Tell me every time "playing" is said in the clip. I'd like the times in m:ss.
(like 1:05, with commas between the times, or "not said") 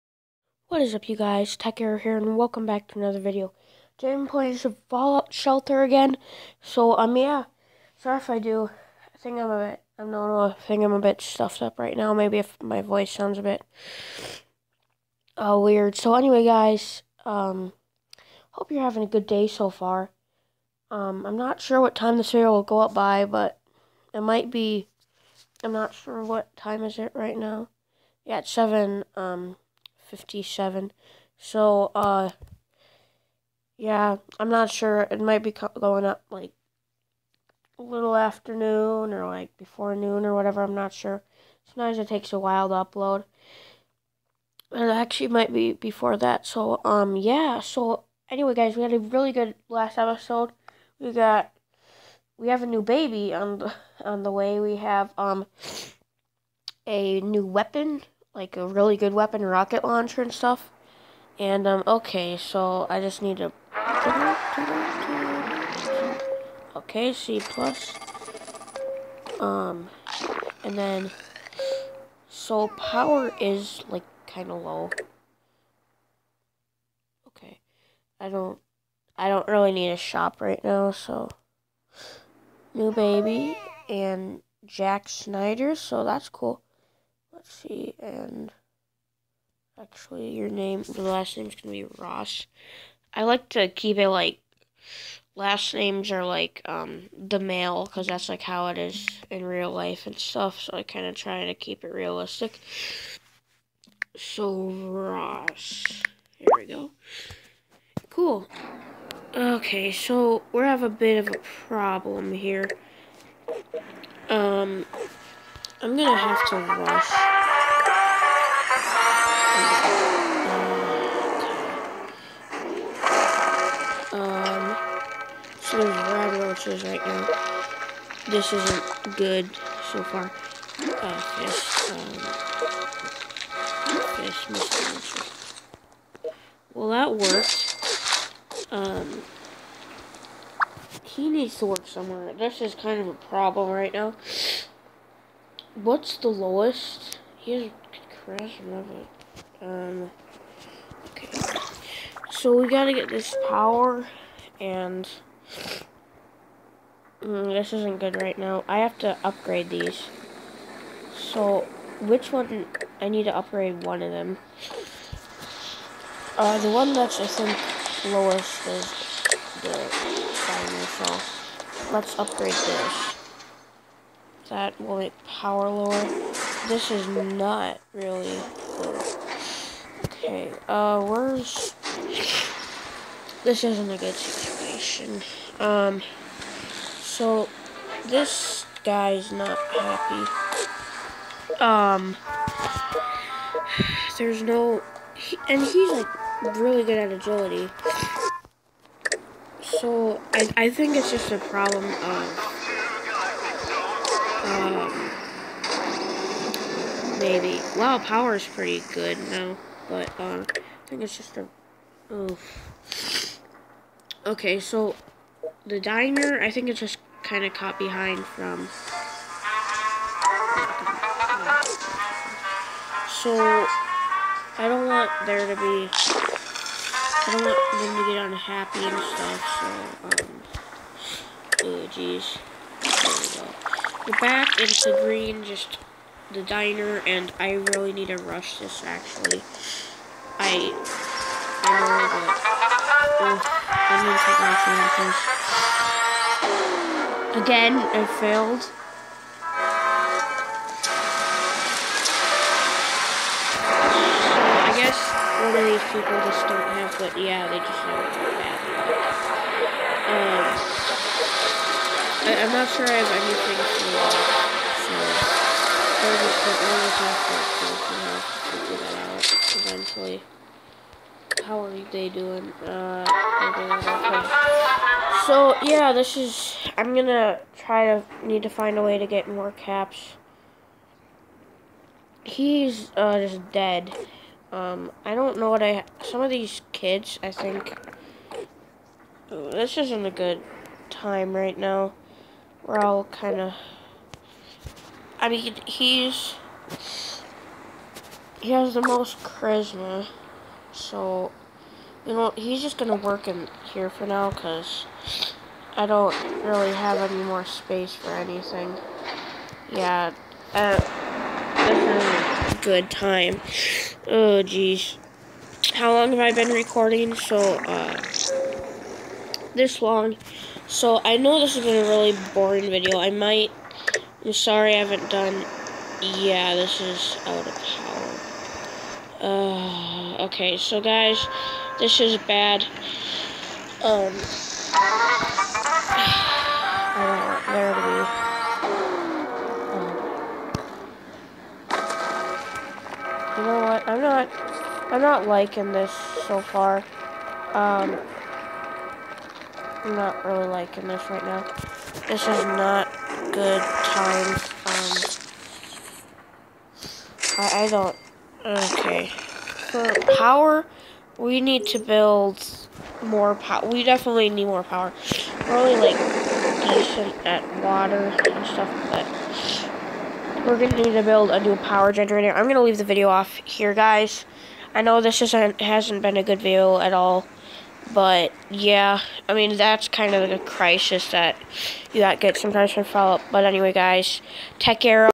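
0:04.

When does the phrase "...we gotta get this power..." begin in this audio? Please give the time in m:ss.
2:32.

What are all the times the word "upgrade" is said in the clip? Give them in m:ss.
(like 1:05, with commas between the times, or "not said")
2:39, 2:43, 2:52.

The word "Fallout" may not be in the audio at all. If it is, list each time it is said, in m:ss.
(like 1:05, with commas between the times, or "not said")
0:04, 6:22.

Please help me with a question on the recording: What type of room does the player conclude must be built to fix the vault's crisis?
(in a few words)
power generator.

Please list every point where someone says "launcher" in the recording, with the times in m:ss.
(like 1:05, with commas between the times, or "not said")
0:59.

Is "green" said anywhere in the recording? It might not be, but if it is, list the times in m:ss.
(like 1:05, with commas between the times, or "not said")
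3:55.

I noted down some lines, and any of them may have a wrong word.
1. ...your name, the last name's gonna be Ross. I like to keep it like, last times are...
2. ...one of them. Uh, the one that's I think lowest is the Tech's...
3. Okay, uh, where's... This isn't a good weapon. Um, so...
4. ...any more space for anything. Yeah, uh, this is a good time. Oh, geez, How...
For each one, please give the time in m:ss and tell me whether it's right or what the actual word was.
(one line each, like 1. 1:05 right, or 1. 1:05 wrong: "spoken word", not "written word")
1. 1:30 wrong: "names", not "times"
2. 2:43 wrong: "Let", not "Tech"
3. 3:00 wrong: "situation", not "weapon"
4. 5:07 right.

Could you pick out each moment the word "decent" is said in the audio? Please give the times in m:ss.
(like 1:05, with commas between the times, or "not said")
6:06.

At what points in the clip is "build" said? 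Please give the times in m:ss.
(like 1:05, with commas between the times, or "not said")
6:01, 6:11.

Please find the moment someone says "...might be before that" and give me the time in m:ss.
0:45.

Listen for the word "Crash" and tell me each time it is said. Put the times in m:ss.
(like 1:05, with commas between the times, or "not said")
2:28.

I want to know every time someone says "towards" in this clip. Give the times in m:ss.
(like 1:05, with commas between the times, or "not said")
not said.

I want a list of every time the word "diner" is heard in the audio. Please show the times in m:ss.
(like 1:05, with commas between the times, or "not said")
3:35, 3:56.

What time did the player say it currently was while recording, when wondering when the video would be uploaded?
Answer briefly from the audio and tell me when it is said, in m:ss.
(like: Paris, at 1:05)
7:57, at 0:28.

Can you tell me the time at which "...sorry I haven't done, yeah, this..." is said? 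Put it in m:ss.
5:24.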